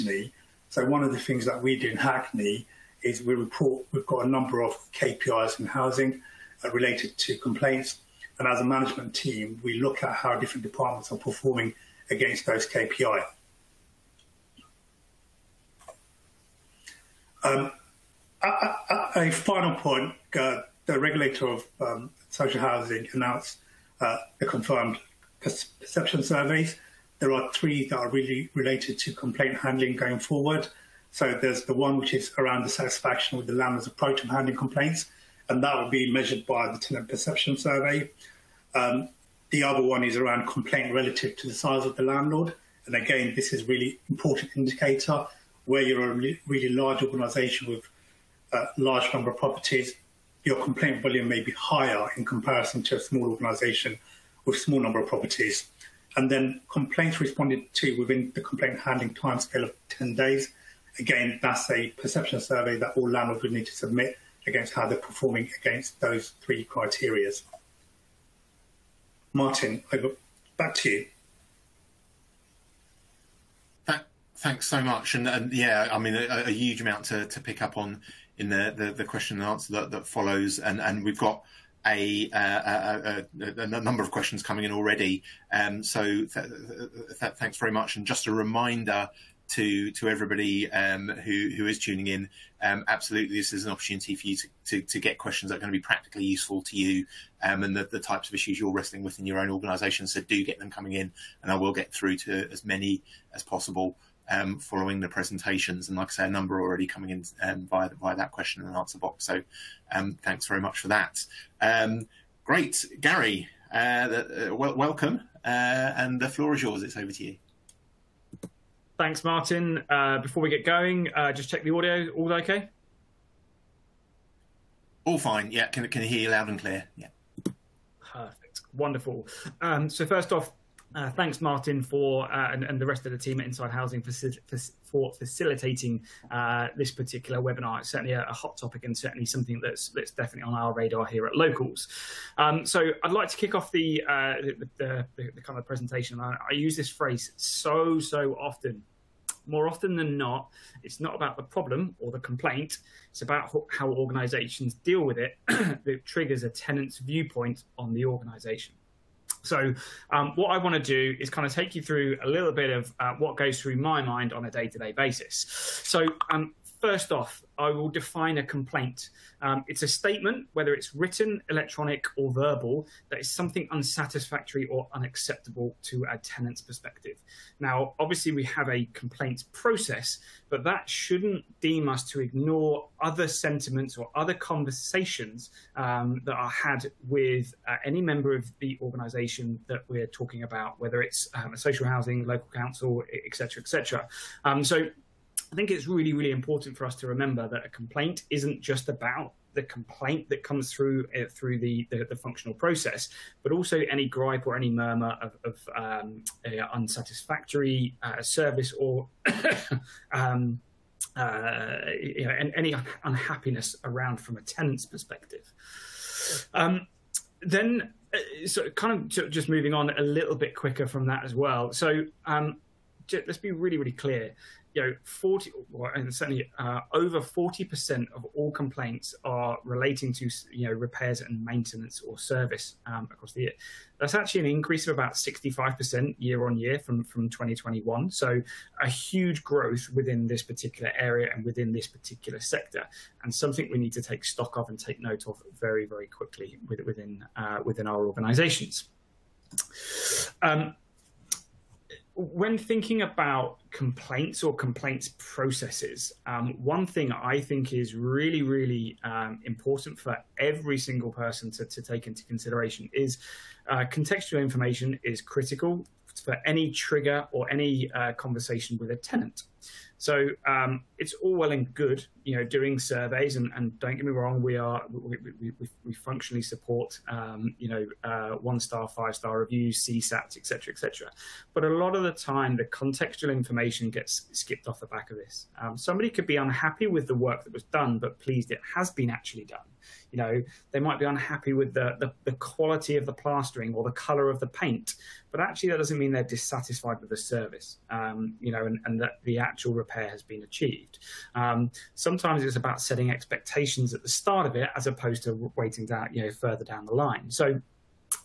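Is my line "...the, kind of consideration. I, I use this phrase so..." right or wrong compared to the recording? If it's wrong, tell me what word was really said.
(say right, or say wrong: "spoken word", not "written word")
wrong: "presentation", not "consideration".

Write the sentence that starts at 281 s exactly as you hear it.
But a lot of the time, the contextual information gets skipped off the back of this.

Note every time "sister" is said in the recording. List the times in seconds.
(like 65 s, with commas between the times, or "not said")
not said.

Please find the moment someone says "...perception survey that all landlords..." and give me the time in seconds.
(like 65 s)
61 s.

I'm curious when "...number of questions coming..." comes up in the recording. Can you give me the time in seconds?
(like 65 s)
83 s.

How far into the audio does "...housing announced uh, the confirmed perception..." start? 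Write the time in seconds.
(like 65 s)
22 s.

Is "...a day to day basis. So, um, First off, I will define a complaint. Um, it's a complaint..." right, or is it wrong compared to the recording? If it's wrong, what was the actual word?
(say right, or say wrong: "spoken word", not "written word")
wrong: "statement", not "complaint".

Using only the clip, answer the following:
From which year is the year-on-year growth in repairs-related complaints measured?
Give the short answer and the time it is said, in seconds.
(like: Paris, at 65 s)
2021, at 237 s.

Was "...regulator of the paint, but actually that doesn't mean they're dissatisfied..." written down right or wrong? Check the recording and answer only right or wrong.
wrong.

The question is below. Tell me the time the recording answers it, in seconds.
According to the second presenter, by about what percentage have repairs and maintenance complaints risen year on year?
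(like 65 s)
235 s.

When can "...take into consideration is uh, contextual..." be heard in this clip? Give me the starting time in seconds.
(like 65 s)
261 s.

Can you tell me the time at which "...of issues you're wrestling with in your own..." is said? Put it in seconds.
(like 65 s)
98 s.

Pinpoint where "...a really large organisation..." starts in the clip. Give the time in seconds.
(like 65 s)
46 s.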